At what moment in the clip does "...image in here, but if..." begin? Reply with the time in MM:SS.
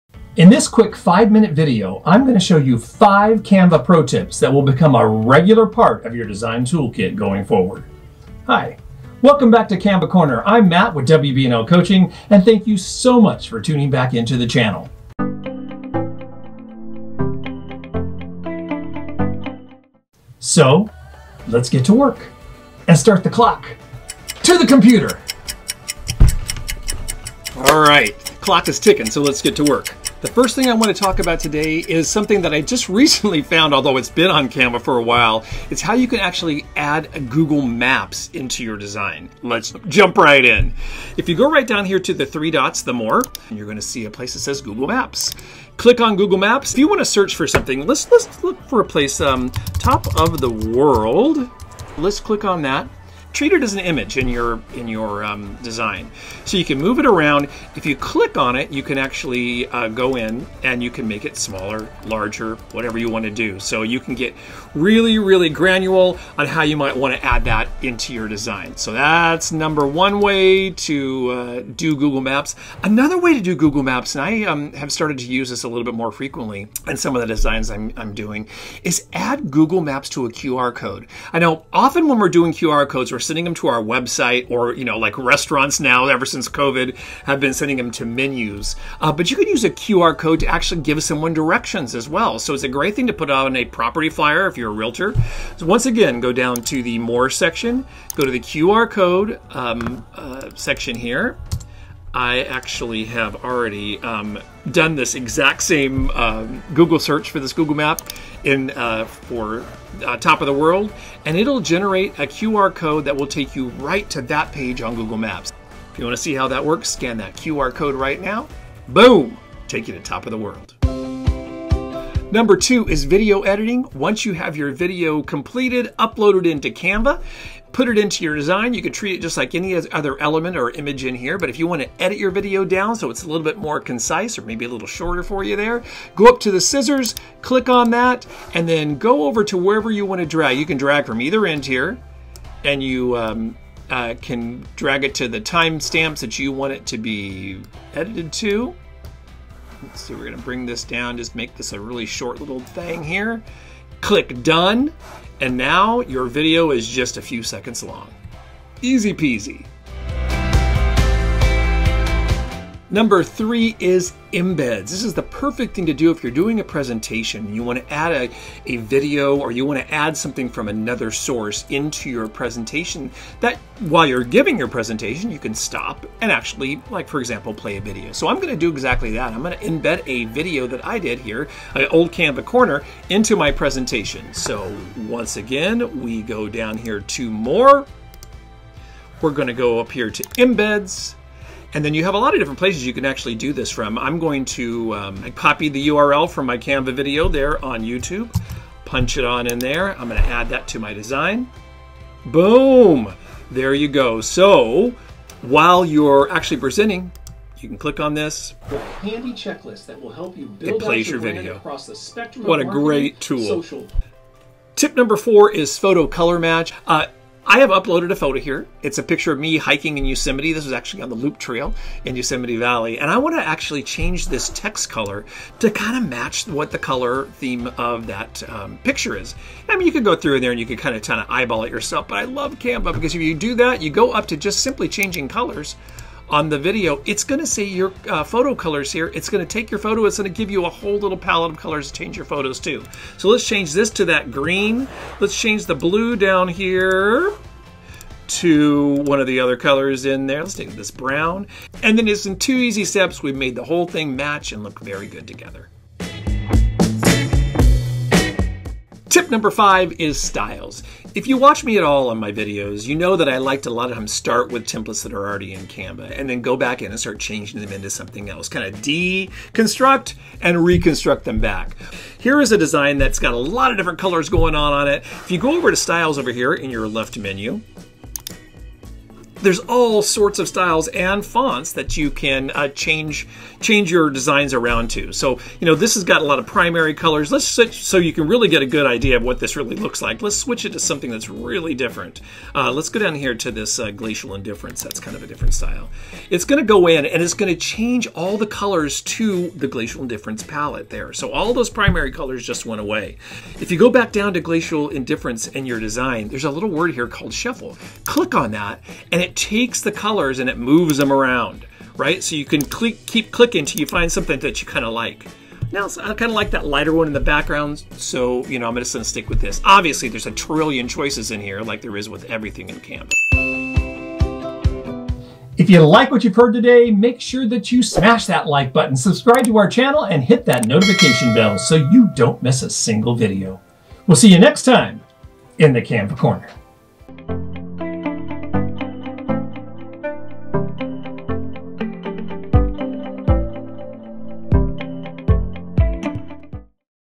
02:10.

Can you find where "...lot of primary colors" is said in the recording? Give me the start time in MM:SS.
04:46.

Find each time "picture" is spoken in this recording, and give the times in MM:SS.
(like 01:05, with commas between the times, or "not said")
03:39, 03:48.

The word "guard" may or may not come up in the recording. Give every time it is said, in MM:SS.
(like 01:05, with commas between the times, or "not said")
not said.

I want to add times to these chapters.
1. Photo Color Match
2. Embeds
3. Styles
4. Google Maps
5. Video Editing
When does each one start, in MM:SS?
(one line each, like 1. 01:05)
1. 03:35
2. 02:44
3. 04:20
4. 00:19
5. 02:02.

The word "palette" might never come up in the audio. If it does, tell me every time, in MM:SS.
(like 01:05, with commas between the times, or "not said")
04:01, 05:00.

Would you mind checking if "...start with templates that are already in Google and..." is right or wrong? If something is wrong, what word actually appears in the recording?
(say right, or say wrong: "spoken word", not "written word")
wrong: "Canva", not "Google".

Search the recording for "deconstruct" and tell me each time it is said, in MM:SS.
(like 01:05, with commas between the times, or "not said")
04:28.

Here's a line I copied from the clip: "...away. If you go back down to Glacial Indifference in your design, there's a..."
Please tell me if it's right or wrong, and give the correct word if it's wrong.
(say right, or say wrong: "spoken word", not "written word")
right.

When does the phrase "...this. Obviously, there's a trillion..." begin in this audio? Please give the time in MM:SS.
05:19.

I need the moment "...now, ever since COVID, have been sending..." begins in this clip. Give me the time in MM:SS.
01:25.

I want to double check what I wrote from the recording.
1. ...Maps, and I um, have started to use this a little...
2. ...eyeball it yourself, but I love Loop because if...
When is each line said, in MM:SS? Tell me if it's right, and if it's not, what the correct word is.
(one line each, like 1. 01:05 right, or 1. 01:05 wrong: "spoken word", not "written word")
1. 01:13 right
2. 03:51 wrong: "Canva", not "Loop".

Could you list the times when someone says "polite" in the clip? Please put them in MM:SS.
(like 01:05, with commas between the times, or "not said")
not said.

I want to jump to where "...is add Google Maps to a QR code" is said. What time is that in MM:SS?
01:18.